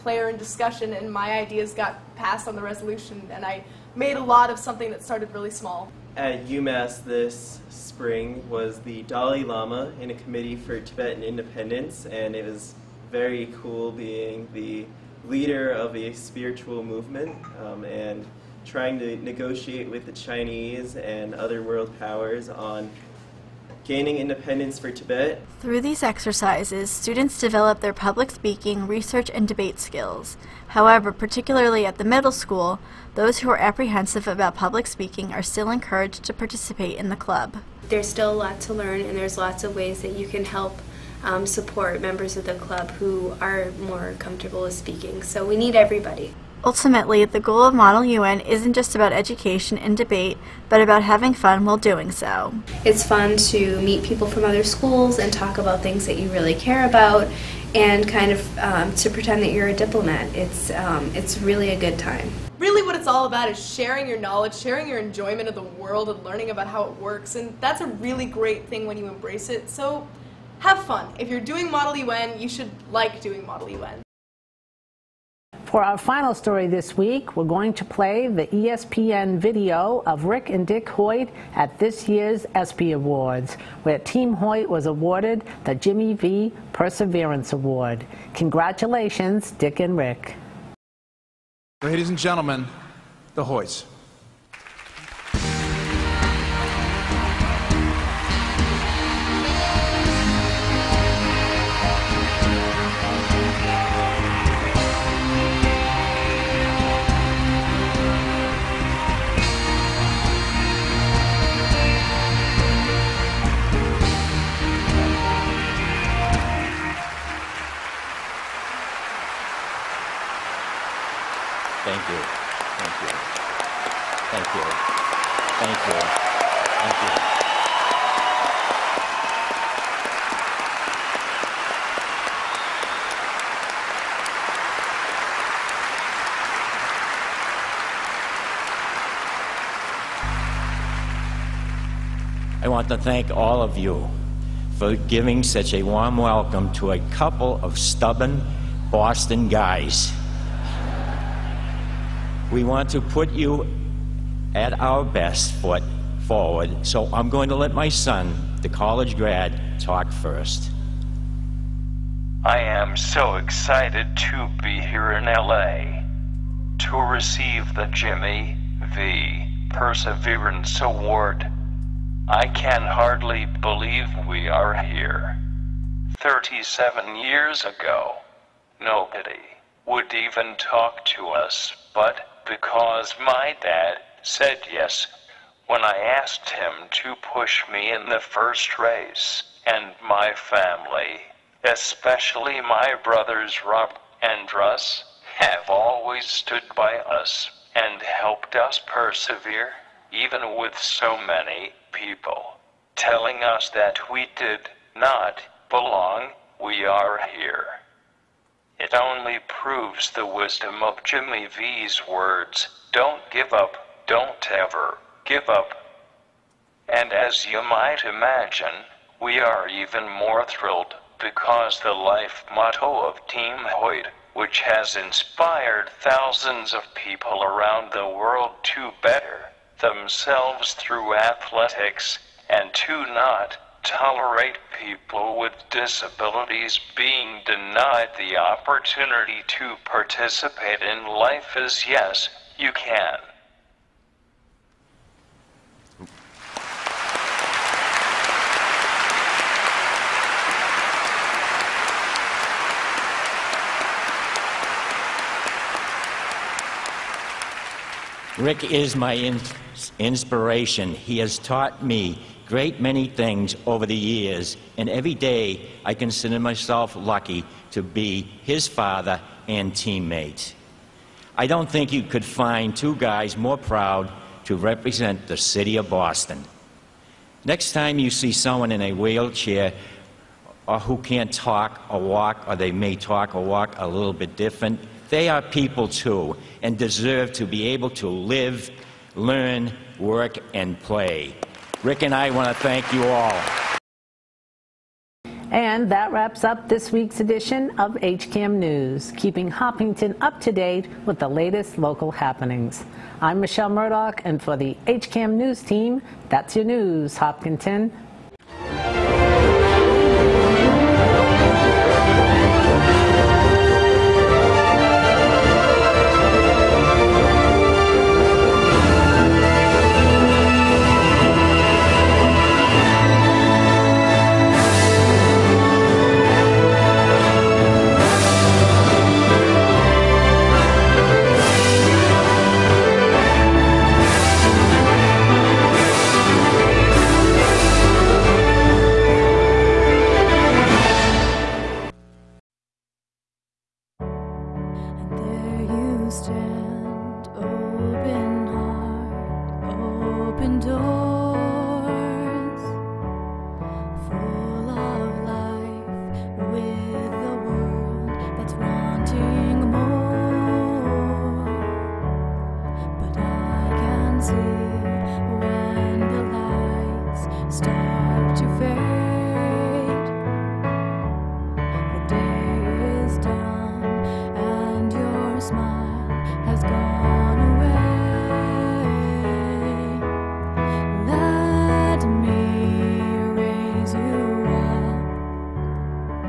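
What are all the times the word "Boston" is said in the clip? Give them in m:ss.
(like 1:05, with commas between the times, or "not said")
2:28, 4:35.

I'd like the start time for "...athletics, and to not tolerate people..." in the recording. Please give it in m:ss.
3:51.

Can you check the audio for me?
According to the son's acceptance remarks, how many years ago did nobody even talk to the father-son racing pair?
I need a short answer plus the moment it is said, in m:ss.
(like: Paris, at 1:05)
37, at 2:56.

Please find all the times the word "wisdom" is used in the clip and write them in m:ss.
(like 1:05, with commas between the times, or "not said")
3:30.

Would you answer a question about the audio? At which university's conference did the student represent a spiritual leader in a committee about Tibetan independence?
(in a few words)
UMass.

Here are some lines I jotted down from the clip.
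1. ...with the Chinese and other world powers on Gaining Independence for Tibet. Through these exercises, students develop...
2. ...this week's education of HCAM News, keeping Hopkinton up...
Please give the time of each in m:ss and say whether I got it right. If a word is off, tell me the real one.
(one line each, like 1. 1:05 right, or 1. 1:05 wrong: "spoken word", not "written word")
1. 0:19 right
2. 4:56 wrong: "edition", not "education".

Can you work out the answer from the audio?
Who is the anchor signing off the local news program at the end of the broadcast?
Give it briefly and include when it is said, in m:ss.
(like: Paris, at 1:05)
Michelle Murdoch, at 5:03.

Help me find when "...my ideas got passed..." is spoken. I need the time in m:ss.
0:01.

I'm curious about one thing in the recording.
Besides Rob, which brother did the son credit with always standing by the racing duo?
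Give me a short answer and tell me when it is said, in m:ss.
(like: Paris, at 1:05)
Russ, at 3:14.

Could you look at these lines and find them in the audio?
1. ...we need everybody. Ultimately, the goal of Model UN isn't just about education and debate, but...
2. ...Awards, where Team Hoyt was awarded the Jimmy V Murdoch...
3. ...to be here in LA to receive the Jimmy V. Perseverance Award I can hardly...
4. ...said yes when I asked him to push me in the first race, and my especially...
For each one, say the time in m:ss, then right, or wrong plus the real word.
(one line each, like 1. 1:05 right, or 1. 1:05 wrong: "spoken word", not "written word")
1. 0:45 right
2. 1:22 wrong: "Perseverance", not "Murdoch"
3. 2:44 right
4. 3:04 wrong: "family", not "especially".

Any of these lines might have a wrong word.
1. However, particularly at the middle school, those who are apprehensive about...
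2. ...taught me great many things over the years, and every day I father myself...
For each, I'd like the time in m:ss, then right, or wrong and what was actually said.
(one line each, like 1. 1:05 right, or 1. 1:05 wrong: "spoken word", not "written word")
1. 0:30 right
2. 4:21 wrong: "consider", not "father".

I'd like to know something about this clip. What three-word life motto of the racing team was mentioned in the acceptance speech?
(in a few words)
Yes, you can.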